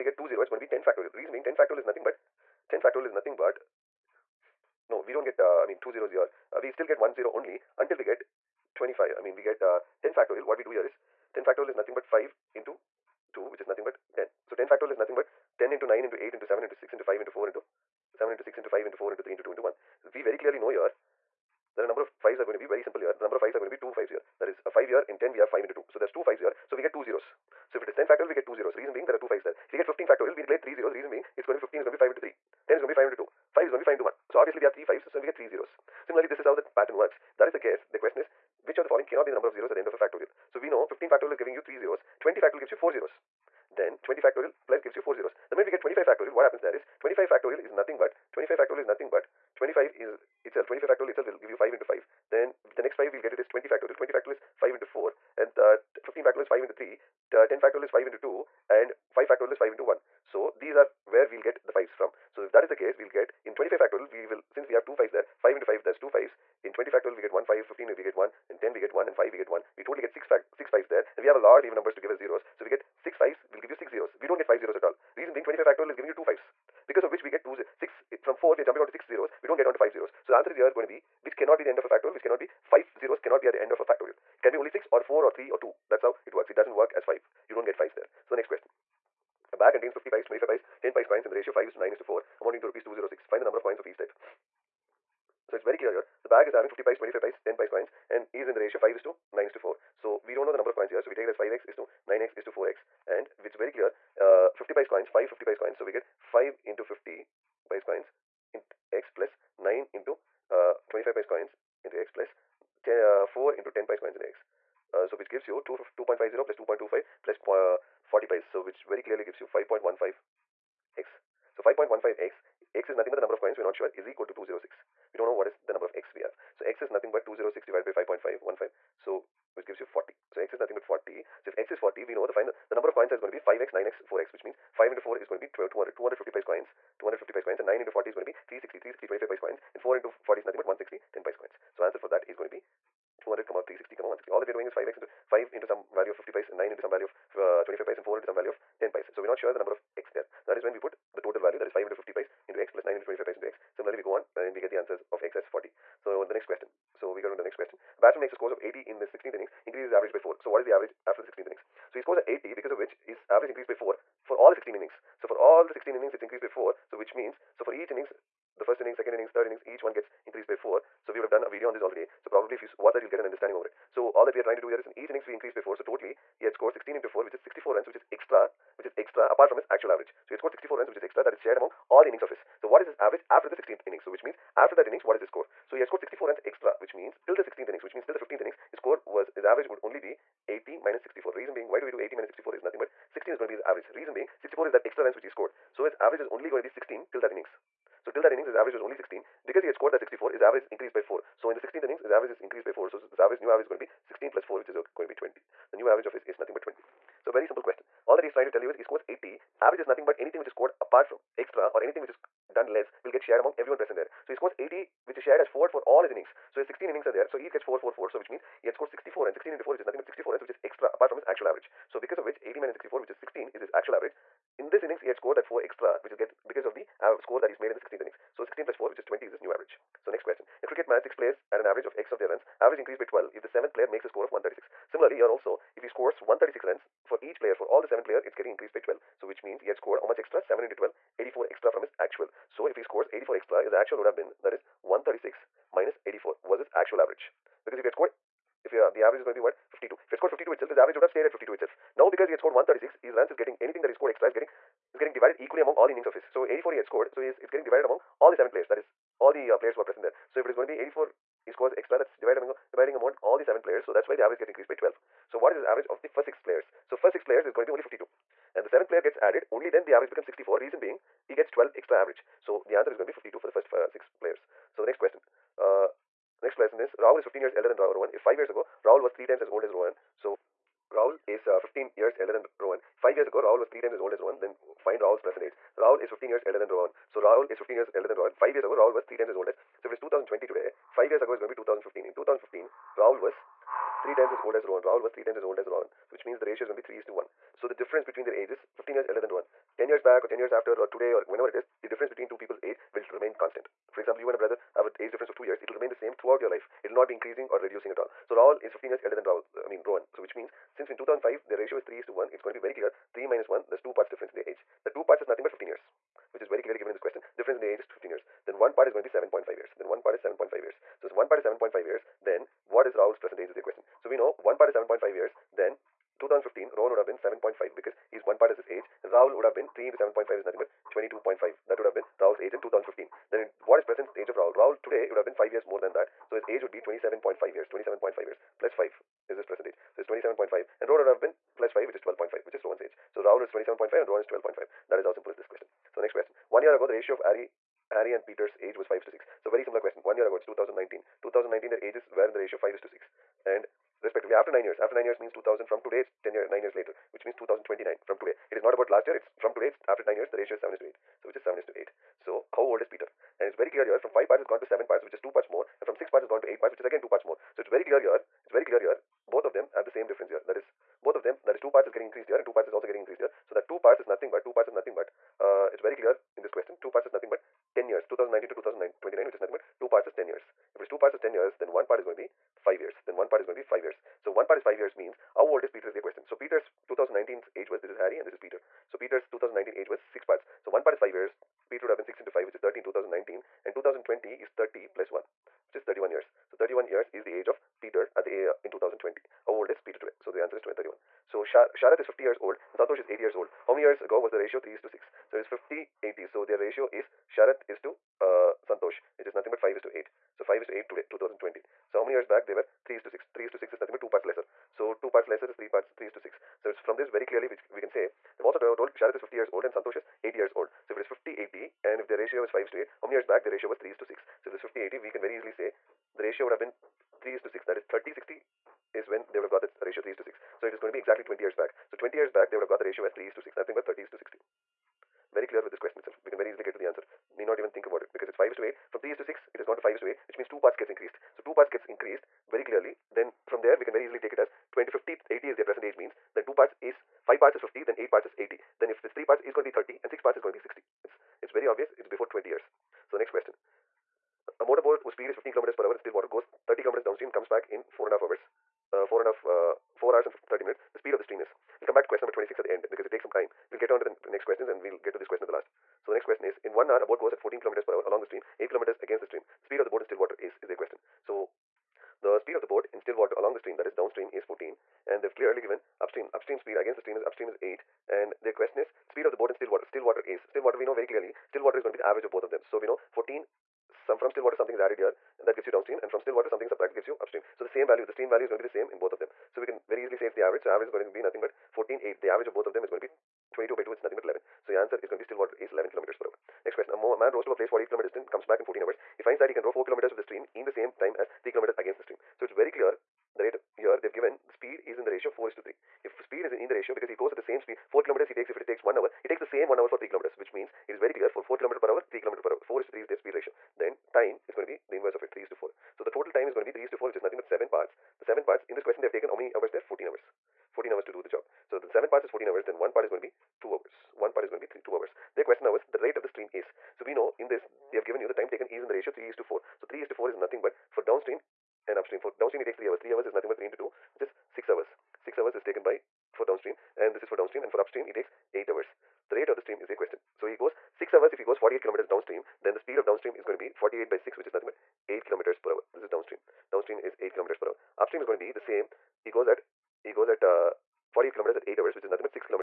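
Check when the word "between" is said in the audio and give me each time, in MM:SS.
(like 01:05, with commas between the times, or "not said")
04:58, 05:02.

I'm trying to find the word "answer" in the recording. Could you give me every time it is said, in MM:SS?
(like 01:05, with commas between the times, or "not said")
01:20, 02:21, 02:34, 04:32, 06:40, 07:16, 08:14.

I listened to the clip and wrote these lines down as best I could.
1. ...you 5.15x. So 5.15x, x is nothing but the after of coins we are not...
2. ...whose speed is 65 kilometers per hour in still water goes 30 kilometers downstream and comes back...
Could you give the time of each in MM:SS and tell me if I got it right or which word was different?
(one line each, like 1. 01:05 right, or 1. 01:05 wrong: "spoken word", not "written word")
1. 01:59 wrong: "number", not "after"
2. 07:35 wrong: "15", not "65".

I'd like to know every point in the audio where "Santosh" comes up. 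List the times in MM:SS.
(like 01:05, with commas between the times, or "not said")
06:42, 06:48, 06:59.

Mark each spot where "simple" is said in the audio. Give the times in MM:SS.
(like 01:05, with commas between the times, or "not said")
00:22, 03:27, 05:45.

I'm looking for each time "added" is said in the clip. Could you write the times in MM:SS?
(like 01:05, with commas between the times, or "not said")
04:29, 08:04.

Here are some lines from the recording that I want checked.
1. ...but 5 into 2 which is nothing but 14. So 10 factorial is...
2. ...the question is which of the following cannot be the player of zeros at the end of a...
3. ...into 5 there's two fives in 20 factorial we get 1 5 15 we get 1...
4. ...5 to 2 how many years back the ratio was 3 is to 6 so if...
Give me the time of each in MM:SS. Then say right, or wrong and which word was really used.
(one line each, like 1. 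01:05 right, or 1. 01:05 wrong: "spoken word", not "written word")
1. 00:11 wrong: "10", not "14"
2. 00:37 wrong: "number", not "player"
3. 01:05 right
4. 07:02 wrong: "8", not "2".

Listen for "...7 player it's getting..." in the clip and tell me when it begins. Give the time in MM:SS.
03:57.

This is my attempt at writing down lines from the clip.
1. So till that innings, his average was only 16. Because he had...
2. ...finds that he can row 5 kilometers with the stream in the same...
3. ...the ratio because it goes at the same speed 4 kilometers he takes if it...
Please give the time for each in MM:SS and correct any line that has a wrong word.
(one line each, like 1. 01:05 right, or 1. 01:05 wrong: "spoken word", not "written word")
1. 03:18 right
2. 08:19 wrong: "4", not "5"
3. 08:26 right.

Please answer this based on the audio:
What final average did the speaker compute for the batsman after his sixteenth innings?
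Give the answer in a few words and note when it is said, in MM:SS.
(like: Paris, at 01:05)
20, at 03:25.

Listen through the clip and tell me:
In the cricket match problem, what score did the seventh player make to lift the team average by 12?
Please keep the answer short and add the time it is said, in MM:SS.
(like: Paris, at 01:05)
136, at 03:53.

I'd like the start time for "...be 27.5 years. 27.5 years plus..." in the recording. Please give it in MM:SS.
05:36.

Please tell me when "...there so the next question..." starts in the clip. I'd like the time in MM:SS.
01:27.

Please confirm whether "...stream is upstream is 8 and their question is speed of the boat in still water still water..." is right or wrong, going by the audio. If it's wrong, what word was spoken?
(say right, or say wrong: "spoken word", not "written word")
right.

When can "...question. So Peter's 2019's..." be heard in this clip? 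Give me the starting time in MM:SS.
06:26.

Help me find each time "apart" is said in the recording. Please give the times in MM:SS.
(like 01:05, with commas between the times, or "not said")
02:59, 03:30, 03:40.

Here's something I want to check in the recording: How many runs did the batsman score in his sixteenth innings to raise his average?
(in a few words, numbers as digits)
80.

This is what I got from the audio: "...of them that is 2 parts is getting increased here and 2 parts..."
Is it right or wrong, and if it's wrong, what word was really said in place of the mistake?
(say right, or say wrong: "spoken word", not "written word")
right.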